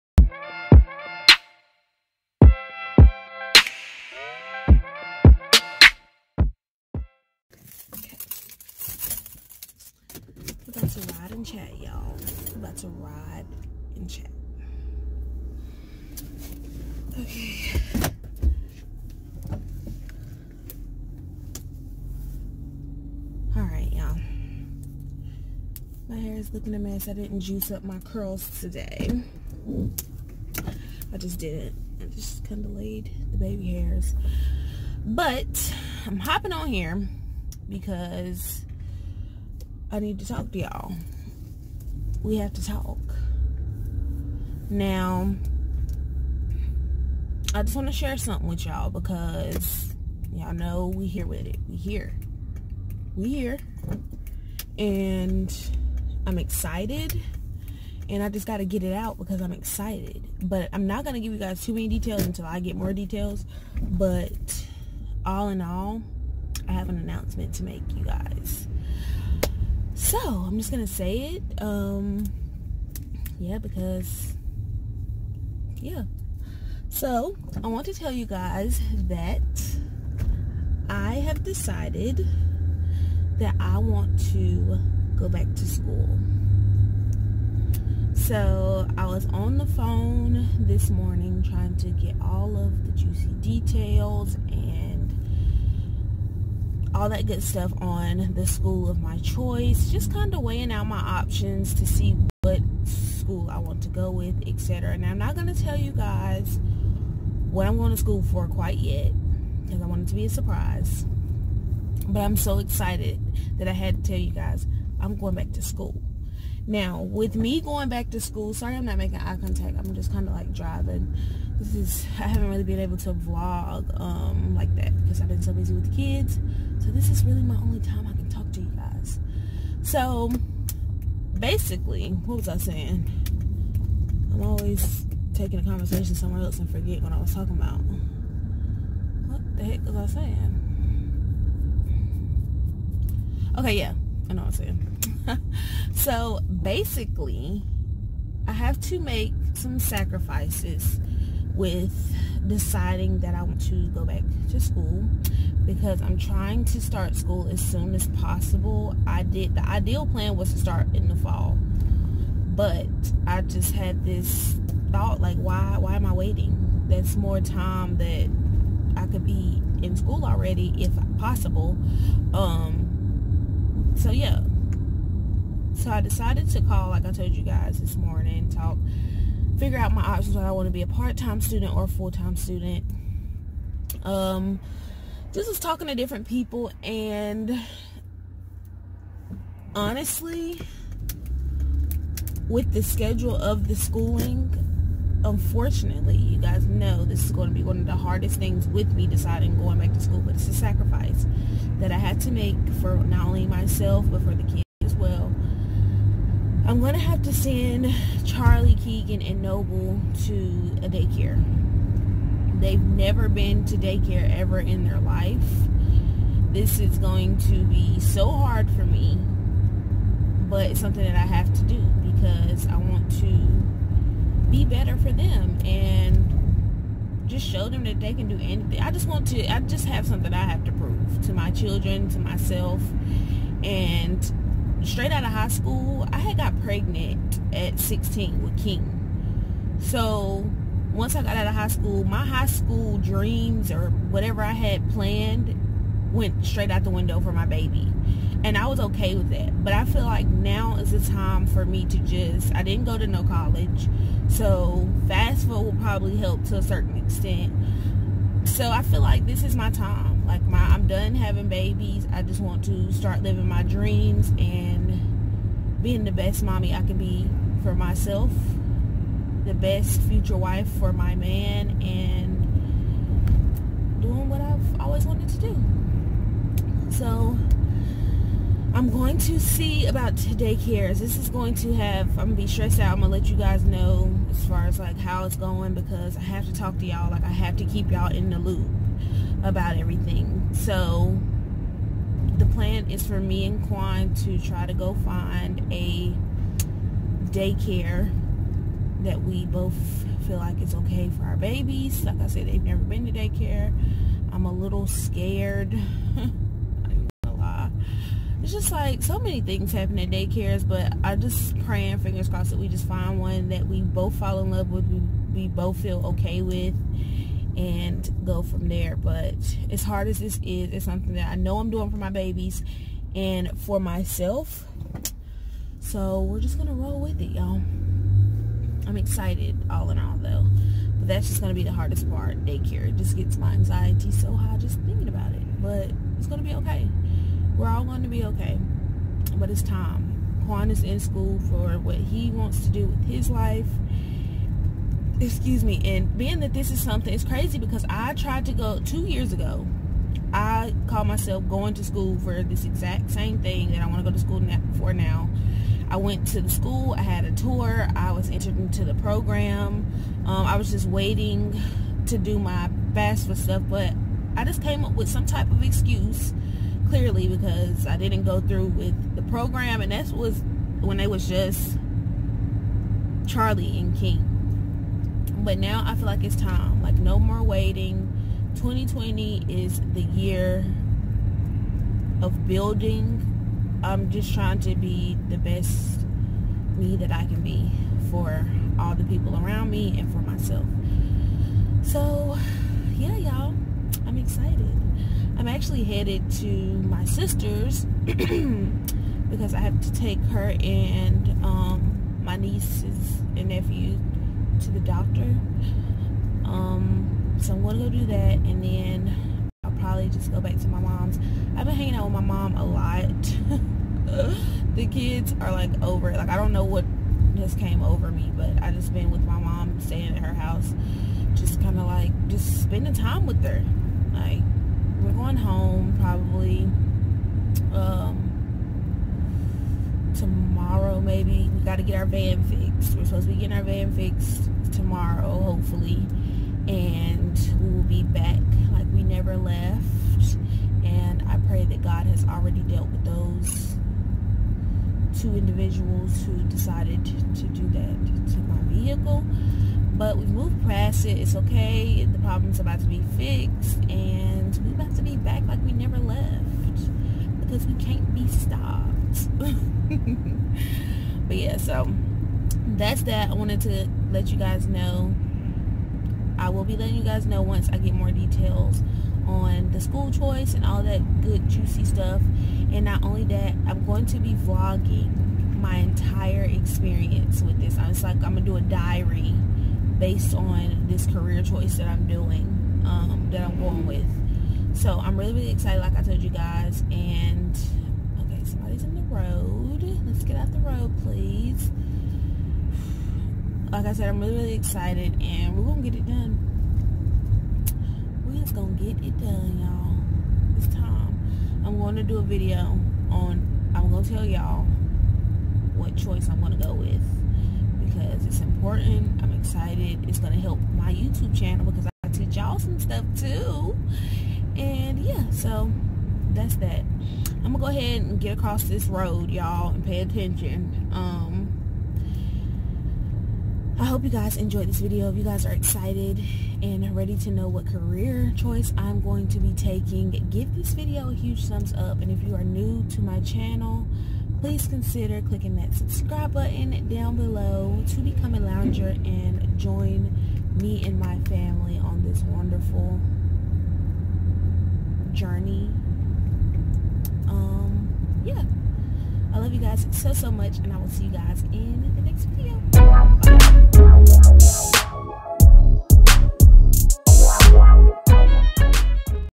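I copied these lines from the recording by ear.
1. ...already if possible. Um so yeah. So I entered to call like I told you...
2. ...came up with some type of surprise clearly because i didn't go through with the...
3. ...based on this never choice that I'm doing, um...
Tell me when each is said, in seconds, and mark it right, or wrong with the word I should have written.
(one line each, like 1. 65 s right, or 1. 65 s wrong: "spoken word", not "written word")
1. 170 s wrong: "decided", not "entered"
2. 364 s wrong: "excuse", not "surprise"
3. 479 s wrong: "career", not "never".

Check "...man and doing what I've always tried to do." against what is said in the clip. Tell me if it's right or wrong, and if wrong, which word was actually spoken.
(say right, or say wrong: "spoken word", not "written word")
wrong: "wanted", not "tried".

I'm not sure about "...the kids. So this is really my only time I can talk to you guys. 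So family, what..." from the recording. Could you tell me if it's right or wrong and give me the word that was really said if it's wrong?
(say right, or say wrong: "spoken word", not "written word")
wrong: "basically", not "family".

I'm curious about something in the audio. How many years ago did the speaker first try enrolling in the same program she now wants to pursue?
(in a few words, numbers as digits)
2.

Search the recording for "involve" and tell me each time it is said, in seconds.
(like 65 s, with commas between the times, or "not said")
not said.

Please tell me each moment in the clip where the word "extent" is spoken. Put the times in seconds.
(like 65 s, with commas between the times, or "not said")
256 s.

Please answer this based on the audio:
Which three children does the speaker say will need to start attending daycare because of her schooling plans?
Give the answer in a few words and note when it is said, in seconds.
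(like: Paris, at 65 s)
Charlie, Keegan, and Noble, at 208 s.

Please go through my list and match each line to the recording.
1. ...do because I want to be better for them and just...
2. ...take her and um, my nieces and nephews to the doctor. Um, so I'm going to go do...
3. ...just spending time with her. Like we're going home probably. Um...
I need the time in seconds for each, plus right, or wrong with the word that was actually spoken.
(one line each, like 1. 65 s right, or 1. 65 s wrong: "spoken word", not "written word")
1. 221 s right
2. 399 s right
3. 422 s right.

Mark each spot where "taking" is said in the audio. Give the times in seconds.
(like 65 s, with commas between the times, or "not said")
135 s, 529 s.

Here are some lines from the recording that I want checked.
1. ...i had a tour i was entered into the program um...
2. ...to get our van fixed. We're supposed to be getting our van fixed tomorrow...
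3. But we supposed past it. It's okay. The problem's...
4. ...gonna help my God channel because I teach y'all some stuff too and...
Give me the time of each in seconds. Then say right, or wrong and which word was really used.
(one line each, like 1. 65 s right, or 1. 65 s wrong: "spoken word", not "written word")
1. 356 s right
2. 431 s right
3. 449 s wrong: "moved", not "supposed"
4. 510 s wrong: "YouTube", not "God".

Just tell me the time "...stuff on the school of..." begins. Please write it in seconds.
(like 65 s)
97 s.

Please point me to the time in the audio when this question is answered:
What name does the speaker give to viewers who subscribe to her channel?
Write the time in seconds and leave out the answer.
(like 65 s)
538 s.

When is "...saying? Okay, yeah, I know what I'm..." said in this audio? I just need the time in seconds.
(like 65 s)
140 s.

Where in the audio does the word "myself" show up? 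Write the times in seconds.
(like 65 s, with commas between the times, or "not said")
203 s, 232 s, 267 s, 323 s, 351 s, 390 s.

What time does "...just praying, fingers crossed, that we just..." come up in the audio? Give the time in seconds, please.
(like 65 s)
311 s.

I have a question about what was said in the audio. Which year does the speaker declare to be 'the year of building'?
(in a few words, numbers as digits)
2020.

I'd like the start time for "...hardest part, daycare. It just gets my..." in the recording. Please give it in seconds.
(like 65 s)
331 s.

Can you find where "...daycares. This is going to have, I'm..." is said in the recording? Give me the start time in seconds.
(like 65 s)
280 s.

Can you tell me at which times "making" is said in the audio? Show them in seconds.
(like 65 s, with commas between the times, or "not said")
118 s.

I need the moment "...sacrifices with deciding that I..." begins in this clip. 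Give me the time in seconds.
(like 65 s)
149 s.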